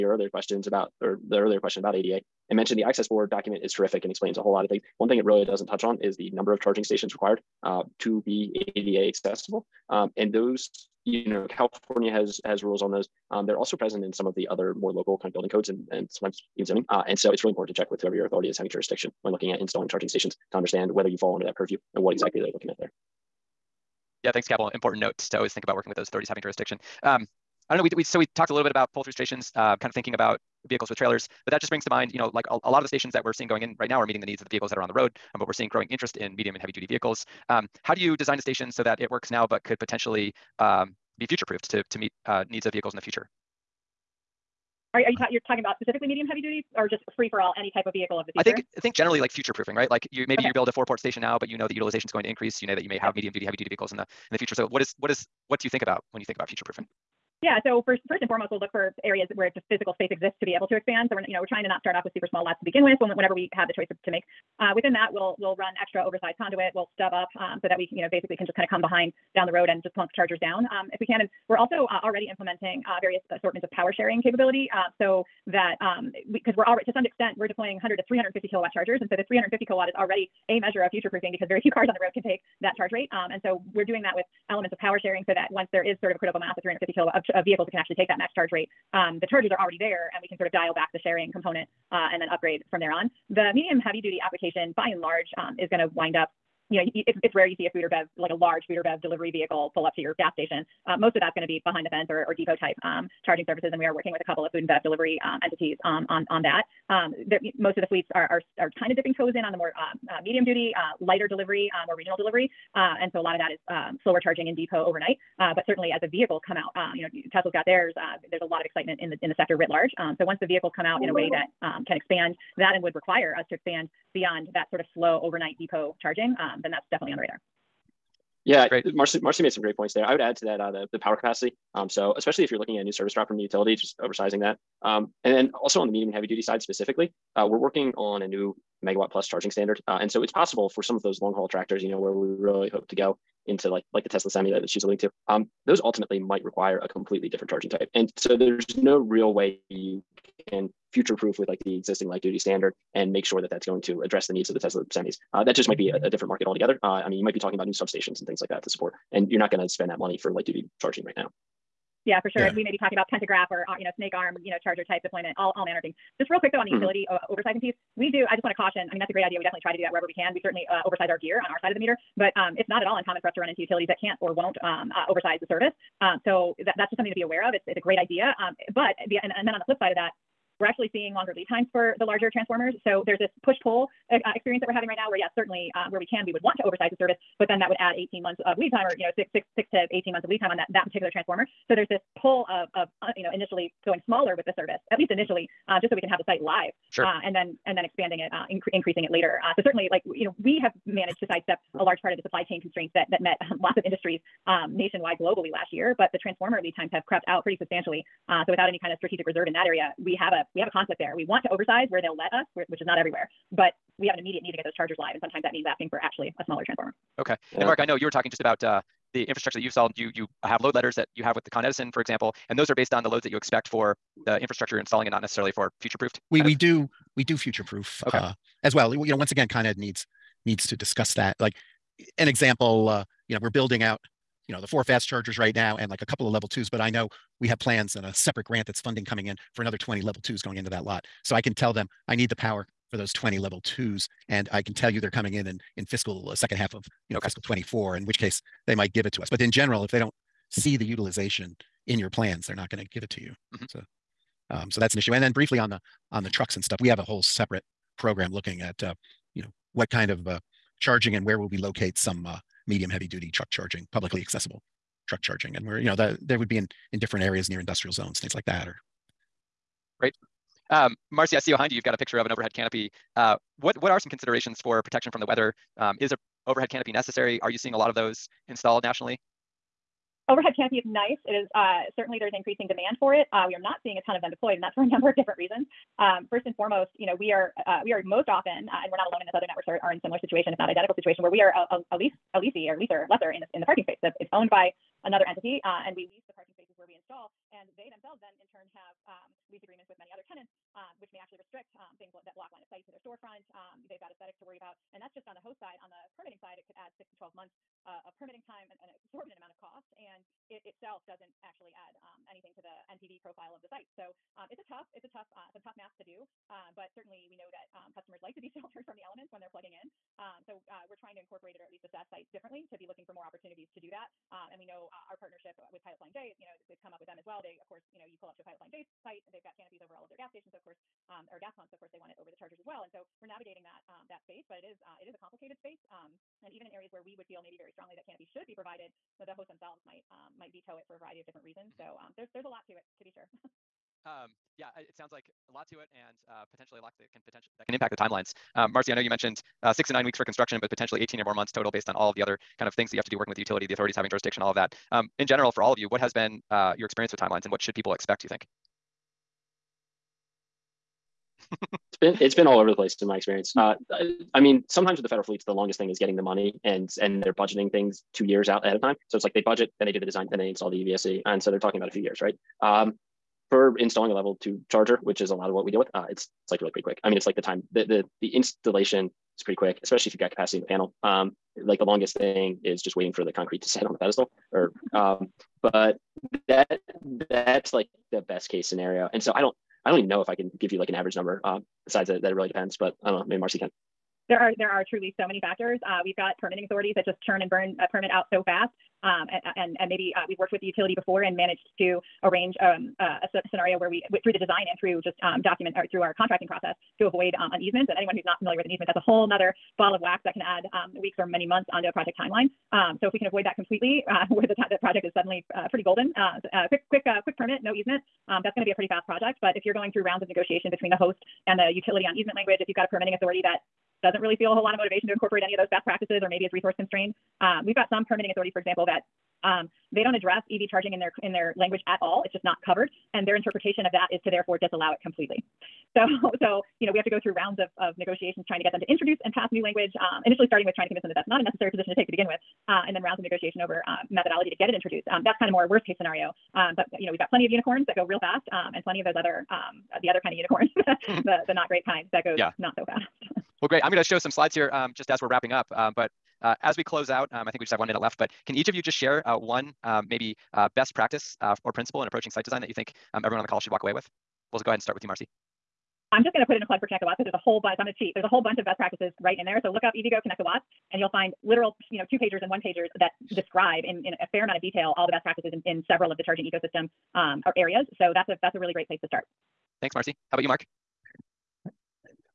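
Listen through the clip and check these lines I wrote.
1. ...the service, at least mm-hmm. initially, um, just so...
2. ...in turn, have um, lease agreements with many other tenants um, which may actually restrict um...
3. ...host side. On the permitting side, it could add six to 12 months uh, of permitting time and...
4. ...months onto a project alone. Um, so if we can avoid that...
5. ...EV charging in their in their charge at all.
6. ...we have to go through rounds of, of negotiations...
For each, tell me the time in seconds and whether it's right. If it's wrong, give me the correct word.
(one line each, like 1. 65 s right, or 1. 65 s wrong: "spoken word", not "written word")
1. 194 s right
2. 298 s right
3. 305 s right
4. 411 s wrong: "timeline", not "alone"
5. 430 s wrong: "language", not "charge"
6. 436 s right.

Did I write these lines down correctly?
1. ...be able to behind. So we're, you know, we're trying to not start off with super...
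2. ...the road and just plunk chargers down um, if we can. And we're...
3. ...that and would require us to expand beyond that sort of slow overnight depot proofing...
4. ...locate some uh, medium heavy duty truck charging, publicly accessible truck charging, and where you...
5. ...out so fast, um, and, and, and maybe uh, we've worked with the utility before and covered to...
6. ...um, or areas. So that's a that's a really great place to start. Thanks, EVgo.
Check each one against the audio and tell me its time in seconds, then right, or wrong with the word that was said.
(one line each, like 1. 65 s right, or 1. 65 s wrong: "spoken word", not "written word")
1. 60 s wrong: "expand", not "behind"
2. 69 s right
3. 122 s wrong: "charging", not "proofing"
4. 261 s right
5. 398 s wrong: "managed", not "covered"
6. 477 s wrong: "Marcy", not "EVgo".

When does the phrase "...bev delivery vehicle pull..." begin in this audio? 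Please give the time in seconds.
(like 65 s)
98 s.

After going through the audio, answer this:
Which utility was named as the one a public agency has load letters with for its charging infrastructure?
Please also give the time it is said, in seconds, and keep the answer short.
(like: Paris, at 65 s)
Con Edison, at 221 s.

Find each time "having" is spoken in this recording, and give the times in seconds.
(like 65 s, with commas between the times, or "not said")
18 s, 26 s, 184 s, 353 s.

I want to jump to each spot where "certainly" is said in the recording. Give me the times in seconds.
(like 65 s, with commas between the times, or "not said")
115 s, 170 s, 185 s, 199 s, 281 s, 316 s.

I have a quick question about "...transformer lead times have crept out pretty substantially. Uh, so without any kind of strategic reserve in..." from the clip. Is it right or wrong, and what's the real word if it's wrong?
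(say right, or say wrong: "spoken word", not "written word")
right.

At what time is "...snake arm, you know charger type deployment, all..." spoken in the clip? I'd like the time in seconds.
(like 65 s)
163 s.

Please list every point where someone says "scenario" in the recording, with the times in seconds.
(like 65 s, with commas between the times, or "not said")
388 s, 403 s, 445 s.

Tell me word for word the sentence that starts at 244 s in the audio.
And I can tell you they're coming in in, in fiscal uh, second half of, you know, okay.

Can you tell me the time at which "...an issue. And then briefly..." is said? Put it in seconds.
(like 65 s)
254 s.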